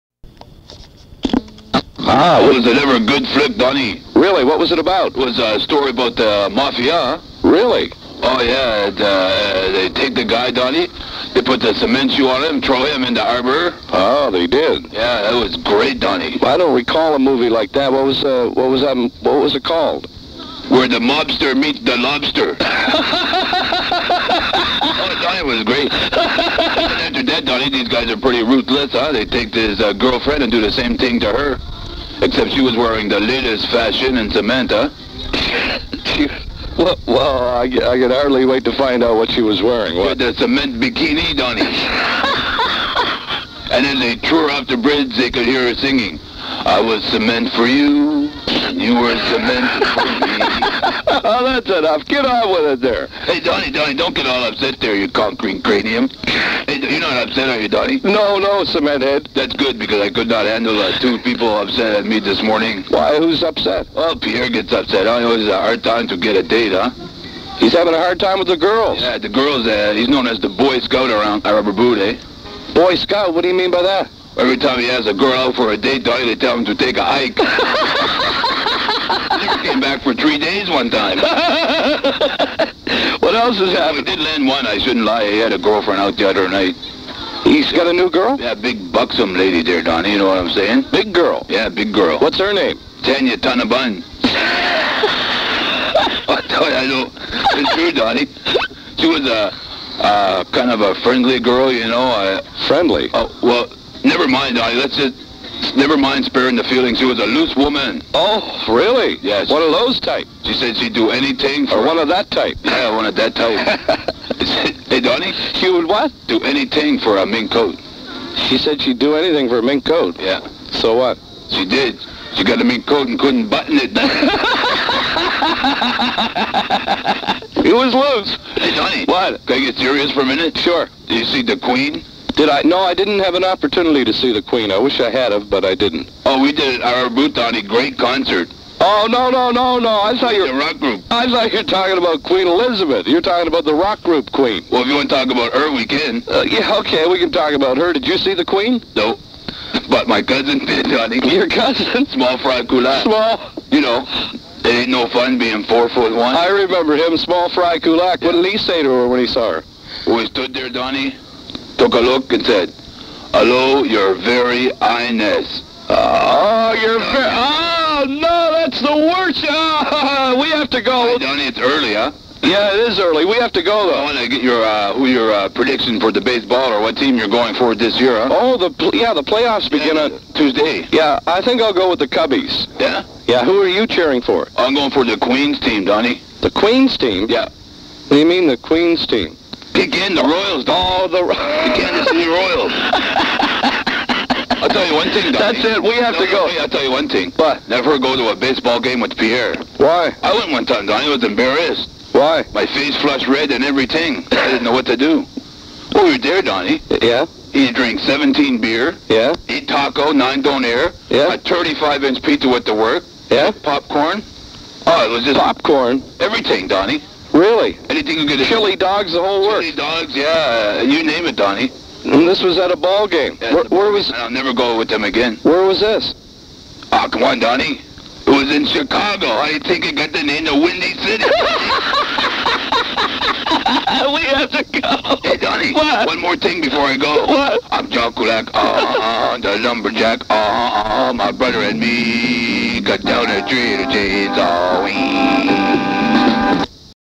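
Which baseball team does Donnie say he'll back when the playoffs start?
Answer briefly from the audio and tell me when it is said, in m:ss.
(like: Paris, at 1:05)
the Cubbies, at 3:01.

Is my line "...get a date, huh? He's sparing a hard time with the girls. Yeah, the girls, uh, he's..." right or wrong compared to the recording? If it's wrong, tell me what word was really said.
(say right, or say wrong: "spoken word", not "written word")
wrong: "having", not "sparing".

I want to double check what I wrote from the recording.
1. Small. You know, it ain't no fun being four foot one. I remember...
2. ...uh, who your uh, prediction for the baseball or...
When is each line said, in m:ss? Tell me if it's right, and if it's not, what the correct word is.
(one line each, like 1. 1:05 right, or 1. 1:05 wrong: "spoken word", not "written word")
1. 2:33 right
2. 2:54 right.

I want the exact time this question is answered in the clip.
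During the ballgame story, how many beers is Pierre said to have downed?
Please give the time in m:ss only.
3:28.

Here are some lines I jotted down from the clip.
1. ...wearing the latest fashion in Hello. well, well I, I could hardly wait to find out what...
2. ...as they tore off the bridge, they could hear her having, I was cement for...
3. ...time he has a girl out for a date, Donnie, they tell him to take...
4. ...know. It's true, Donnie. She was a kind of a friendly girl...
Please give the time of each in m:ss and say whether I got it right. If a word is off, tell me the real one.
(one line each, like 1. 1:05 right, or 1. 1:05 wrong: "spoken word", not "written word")
1. 0:32 wrong: "Samantha", not "Hello"
2. 0:43 wrong: "singing", not "having"
3. 1:14 right
4. 1:36 right.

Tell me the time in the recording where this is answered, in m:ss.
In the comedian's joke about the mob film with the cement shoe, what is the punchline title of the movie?
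0:20.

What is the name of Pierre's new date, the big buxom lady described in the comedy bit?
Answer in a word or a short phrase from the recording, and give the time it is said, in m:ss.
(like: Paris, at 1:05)
Tanya Tonabun, at 1:33.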